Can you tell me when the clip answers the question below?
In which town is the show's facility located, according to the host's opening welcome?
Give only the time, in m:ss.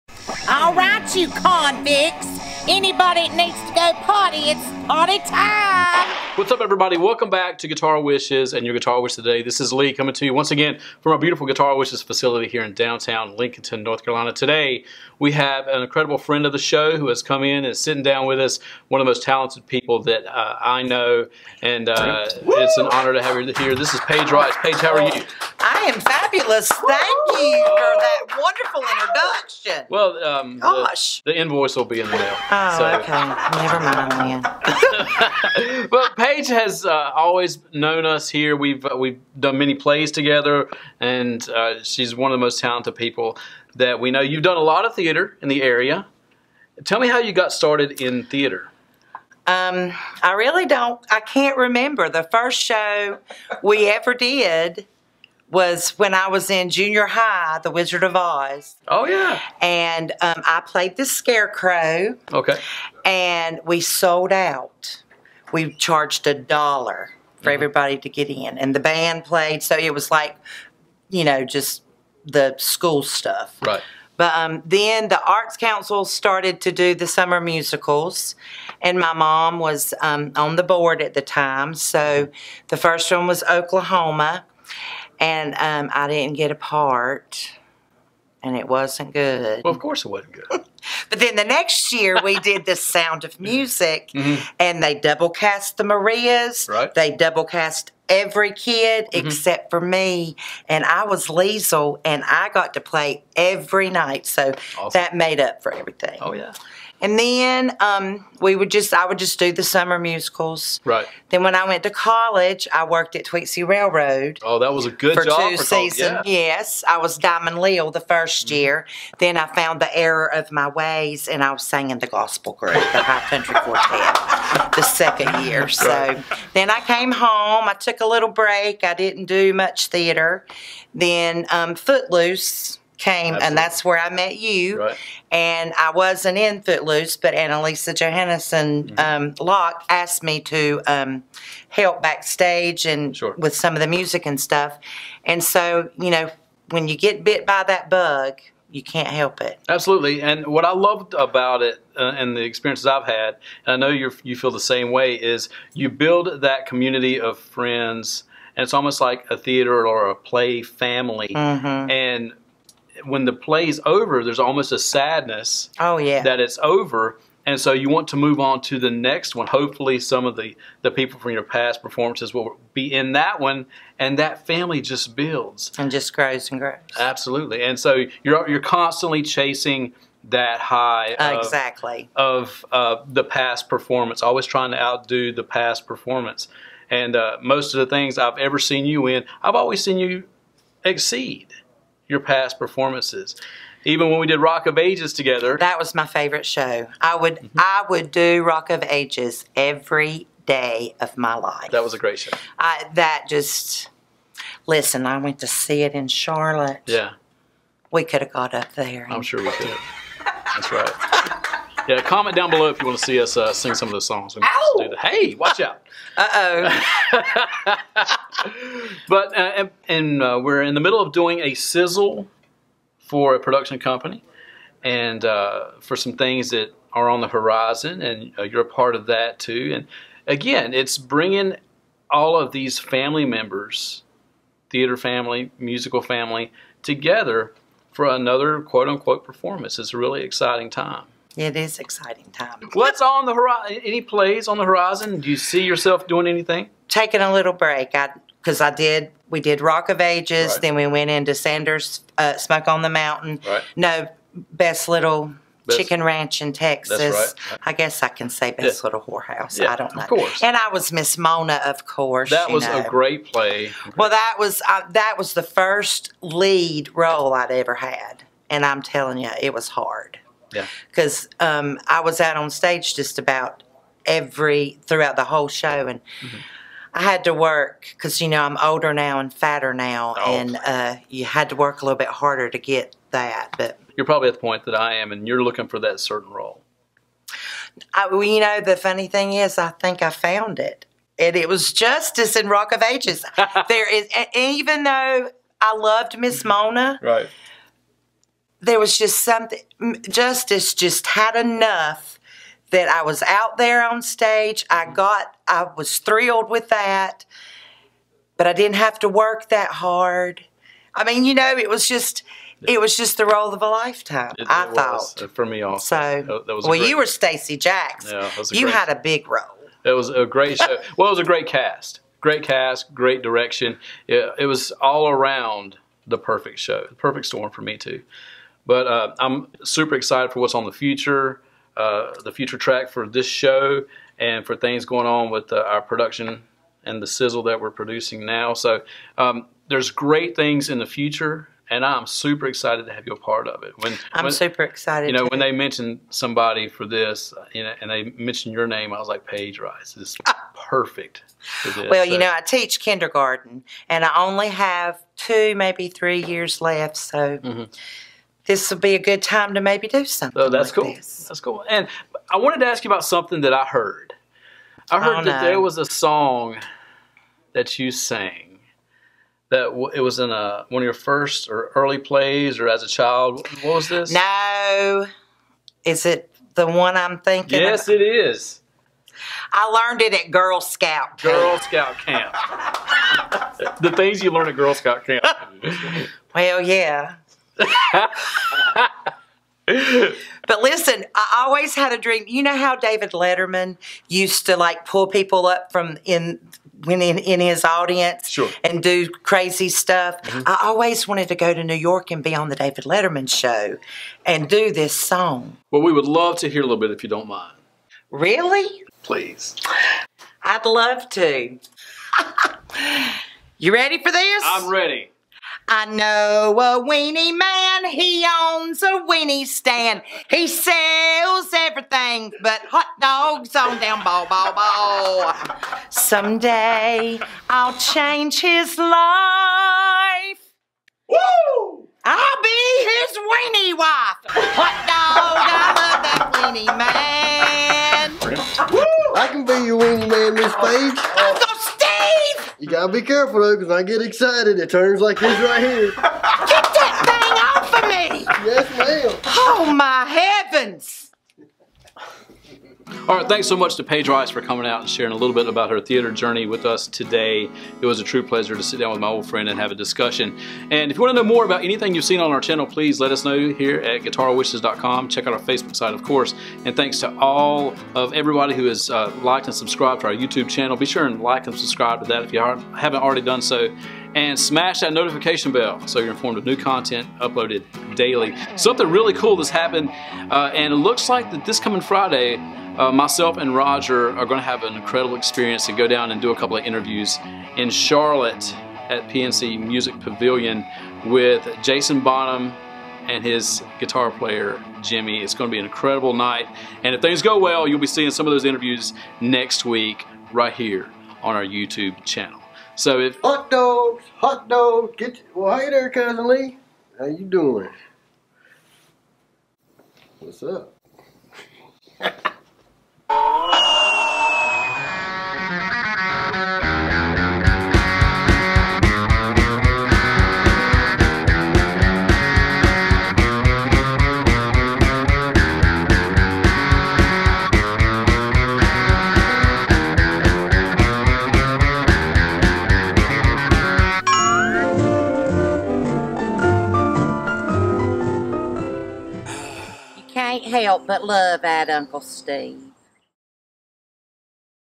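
0:13.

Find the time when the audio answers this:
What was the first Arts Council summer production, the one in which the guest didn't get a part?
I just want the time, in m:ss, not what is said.
1:23.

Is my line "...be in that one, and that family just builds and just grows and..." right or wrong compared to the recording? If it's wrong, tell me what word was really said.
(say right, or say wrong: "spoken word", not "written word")
right.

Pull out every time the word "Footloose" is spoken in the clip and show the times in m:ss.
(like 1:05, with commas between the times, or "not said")
2:11, 2:16.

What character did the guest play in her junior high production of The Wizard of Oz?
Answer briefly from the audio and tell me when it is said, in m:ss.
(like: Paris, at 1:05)
the scarecrow, at 1:00.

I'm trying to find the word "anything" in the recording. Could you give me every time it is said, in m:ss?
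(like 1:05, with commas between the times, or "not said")
4:06, 7:41.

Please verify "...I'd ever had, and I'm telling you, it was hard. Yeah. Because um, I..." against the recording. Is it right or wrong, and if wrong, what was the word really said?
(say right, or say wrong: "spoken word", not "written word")
right.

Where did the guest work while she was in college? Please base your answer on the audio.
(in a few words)
Tweetsie Railroad.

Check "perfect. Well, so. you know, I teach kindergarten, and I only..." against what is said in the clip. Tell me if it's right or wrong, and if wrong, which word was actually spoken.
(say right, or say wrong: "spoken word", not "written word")
right.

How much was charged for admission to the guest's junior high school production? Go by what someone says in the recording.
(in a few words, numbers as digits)
$1.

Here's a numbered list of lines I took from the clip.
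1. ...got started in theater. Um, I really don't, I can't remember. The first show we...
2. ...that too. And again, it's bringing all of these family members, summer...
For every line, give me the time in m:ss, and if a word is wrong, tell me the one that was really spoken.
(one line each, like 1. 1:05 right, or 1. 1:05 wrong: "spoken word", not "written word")
1. 0:47 right
2. 3:49 wrong: "theater", not "summer".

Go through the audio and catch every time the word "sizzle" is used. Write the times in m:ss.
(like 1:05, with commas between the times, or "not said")
3:41, 5:37.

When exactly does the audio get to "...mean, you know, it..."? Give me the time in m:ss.
5:11.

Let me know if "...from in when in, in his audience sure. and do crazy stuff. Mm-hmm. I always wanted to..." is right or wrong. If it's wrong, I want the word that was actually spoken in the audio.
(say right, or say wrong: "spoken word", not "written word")
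right.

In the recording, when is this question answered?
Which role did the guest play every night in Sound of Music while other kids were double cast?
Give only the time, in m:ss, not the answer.
1:41.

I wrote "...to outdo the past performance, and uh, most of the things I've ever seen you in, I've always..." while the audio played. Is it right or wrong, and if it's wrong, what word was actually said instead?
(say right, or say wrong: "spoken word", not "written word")
right.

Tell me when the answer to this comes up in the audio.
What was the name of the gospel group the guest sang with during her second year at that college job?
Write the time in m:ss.
2:02.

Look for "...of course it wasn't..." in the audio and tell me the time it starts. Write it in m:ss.
1:29.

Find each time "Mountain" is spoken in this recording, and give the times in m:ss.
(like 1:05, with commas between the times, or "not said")
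4:12.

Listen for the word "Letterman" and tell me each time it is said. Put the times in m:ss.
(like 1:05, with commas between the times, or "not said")
6:33, 6:42.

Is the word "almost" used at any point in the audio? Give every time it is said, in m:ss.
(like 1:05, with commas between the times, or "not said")
2:38, 2:44.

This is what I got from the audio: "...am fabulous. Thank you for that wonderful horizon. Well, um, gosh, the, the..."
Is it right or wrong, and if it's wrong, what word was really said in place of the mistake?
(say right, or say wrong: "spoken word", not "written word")
wrong: "introduction", not "horizon".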